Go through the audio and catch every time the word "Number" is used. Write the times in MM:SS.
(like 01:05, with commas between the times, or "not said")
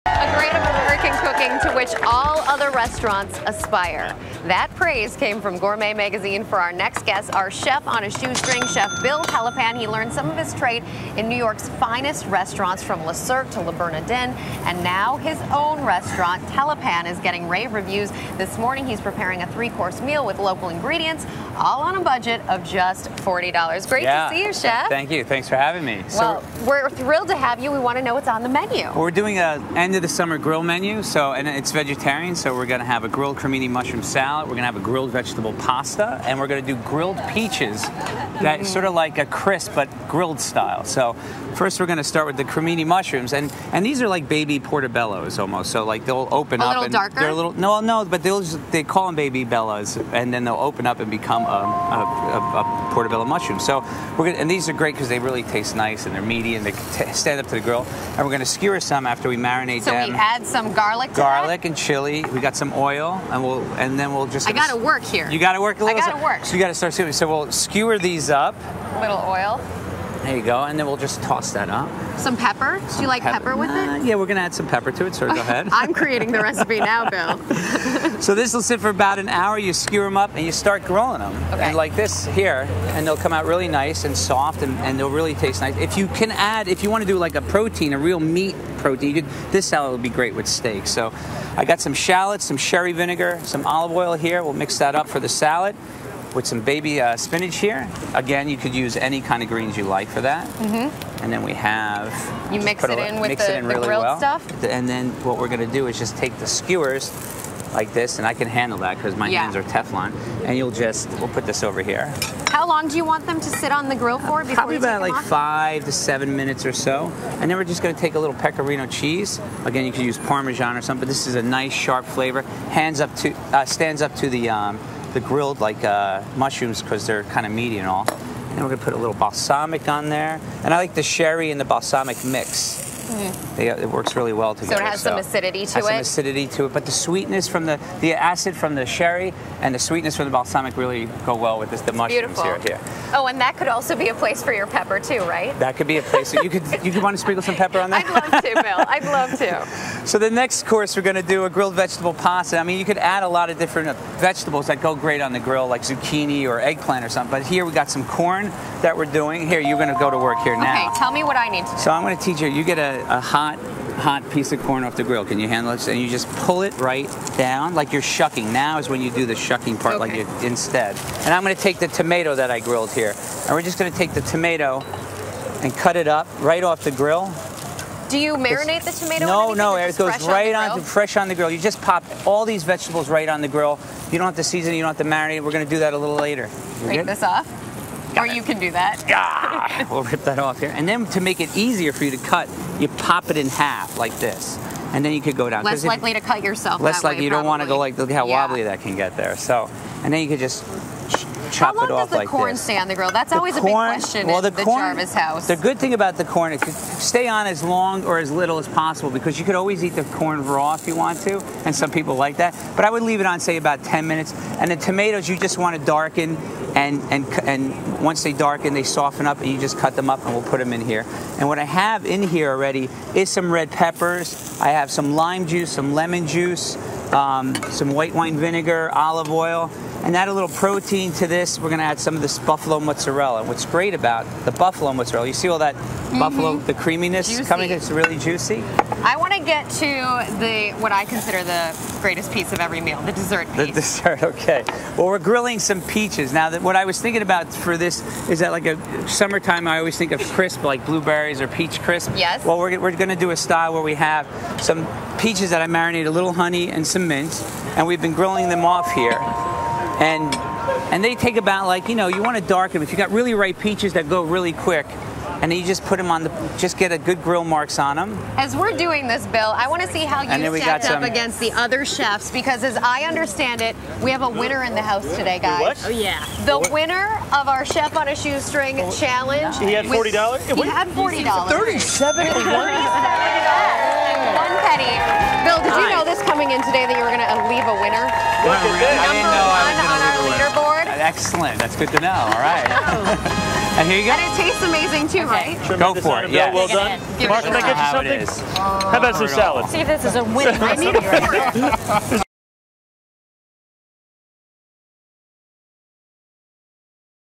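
04:49.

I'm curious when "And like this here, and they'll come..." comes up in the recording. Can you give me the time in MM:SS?
01:21.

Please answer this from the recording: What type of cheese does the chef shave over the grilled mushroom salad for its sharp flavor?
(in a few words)
pecorino.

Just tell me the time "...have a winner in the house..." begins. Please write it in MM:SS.
04:34.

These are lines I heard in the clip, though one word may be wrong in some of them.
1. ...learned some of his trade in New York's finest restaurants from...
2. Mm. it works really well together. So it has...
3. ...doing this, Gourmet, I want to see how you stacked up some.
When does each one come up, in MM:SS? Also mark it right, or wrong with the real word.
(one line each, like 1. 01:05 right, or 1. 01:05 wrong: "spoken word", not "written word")
1. 00:09 right
2. 02:13 right
3. 04:28 wrong: "Bill", not "Gourmet".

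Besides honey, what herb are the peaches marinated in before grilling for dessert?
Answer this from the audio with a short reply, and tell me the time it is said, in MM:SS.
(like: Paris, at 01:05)
mint, at 04:17.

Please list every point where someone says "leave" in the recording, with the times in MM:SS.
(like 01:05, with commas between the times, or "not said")
03:33, 04:47.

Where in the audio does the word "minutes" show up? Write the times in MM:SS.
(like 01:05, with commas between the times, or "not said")
01:56, 03:34.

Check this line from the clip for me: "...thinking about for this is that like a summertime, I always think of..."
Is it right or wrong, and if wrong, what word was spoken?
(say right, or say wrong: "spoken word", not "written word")
right.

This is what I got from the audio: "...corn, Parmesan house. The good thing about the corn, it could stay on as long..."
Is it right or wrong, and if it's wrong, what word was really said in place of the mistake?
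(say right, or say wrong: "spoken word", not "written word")
wrong: "Jarvis", not "Parmesan".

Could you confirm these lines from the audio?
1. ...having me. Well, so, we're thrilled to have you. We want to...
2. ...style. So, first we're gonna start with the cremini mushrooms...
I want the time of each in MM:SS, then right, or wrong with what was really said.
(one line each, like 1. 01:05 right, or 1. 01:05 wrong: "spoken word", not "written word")
1. 00:25 right
2. 00:40 right.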